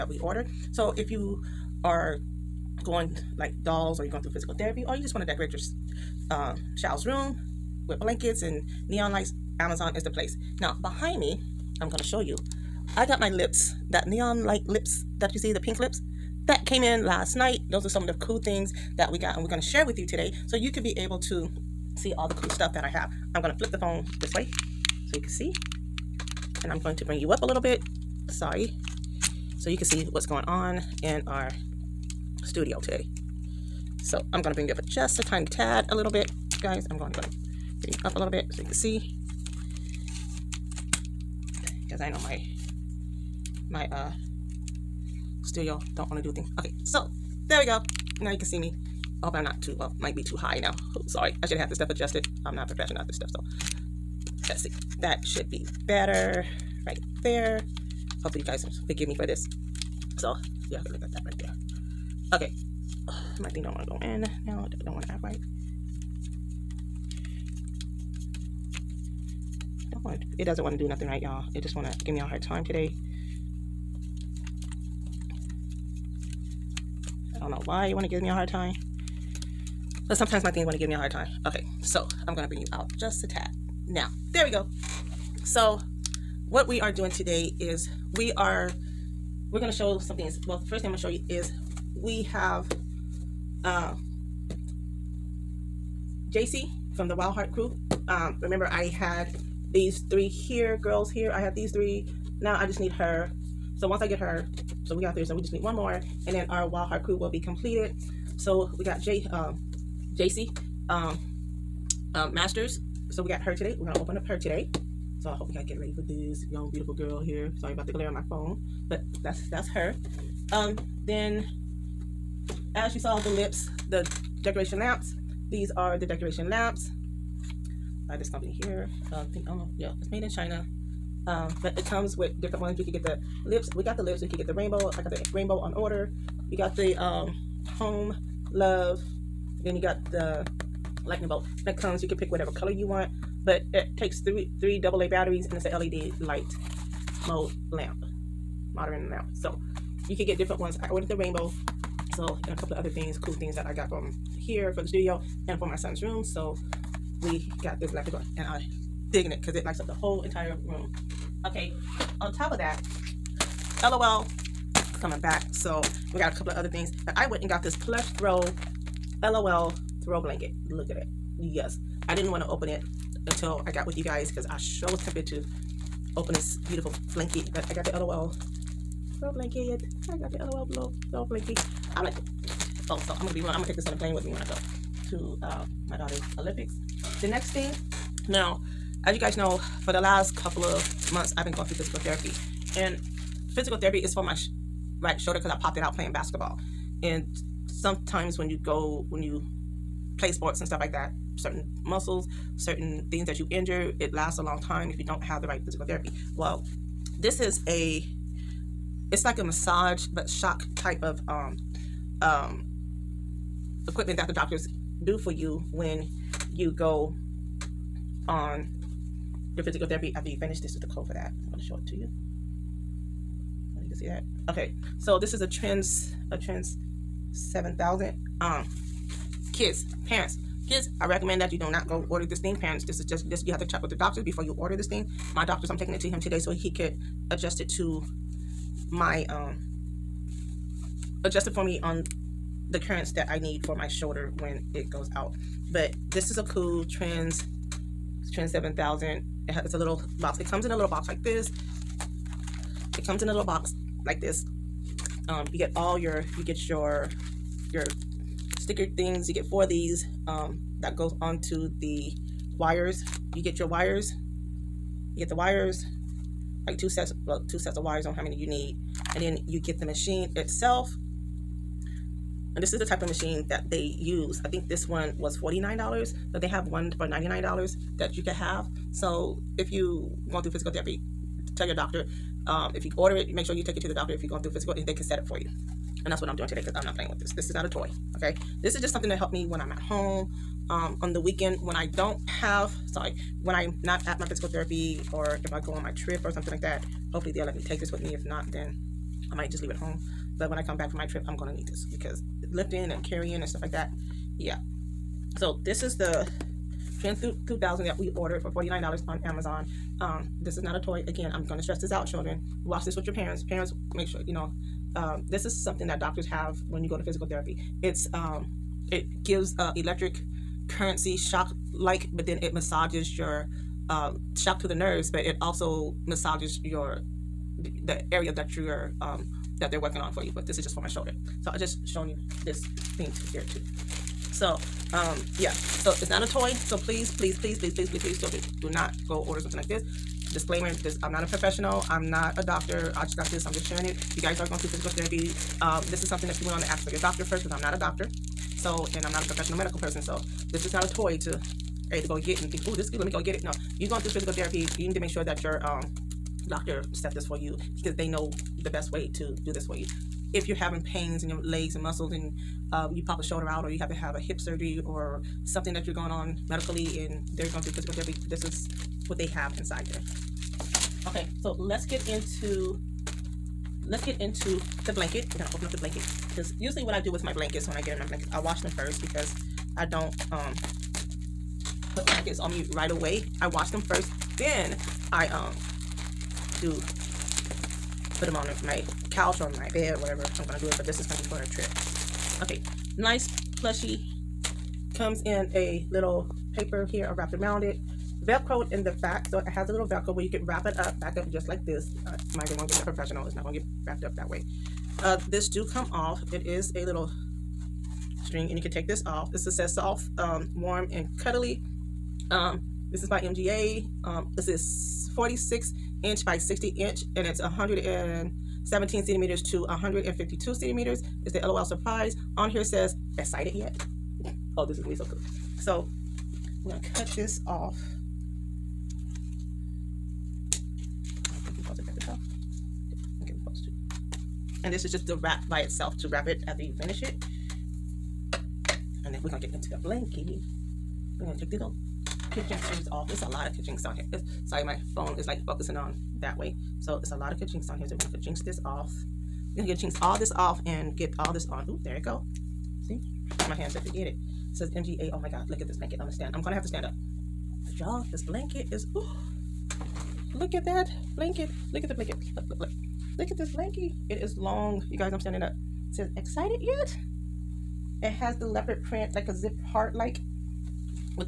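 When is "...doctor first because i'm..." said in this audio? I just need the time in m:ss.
5:46.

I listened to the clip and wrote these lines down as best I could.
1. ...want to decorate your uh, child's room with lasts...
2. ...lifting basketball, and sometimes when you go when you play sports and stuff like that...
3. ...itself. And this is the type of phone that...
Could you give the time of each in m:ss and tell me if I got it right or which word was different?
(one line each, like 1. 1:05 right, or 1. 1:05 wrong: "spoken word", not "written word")
1. 0:05 wrong: "blankets", not "lasts"
2. 3:15 wrong: "playing", not "lifting"
3. 4:30 wrong: "machine", not "phone".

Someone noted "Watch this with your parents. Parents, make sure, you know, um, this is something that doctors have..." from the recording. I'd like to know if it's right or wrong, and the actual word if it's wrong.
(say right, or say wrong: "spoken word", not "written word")
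right.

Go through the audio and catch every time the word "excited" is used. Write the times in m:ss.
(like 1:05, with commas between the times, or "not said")
7:03, 7:46.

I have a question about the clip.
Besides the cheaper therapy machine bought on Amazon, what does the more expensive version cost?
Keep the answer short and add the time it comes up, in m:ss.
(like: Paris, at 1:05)
$99, at 4:37.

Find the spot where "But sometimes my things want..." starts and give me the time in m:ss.
1:20.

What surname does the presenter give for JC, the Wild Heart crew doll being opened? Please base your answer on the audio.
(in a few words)
Masters.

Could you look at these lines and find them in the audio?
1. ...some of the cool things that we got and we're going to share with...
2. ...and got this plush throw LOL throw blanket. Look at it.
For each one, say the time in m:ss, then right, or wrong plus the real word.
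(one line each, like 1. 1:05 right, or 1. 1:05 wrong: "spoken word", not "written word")
1. 0:17 right
2. 2:47 right.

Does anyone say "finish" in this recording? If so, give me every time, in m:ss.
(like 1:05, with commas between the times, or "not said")
3:40, 7:16.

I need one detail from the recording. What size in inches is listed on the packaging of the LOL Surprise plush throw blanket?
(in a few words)
46 by 60 inches.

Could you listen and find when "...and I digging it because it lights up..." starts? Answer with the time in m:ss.
2:38.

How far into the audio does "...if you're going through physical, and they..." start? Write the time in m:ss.
4:44.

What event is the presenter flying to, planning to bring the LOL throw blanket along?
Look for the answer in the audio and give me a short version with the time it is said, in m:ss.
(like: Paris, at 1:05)
Daughter's Olympics, at 3:05.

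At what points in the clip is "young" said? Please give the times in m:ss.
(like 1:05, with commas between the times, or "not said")
1:56.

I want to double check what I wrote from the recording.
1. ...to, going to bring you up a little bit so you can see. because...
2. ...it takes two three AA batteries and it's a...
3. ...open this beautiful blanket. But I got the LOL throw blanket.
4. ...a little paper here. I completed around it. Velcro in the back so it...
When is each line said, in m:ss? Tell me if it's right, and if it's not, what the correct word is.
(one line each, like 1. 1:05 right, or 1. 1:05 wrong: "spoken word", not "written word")
1. 0:37 right
2. 2:23 wrong: "three", not "two"
3. 2:56 right
4. 6:35 wrong: "wrapped", not "completed".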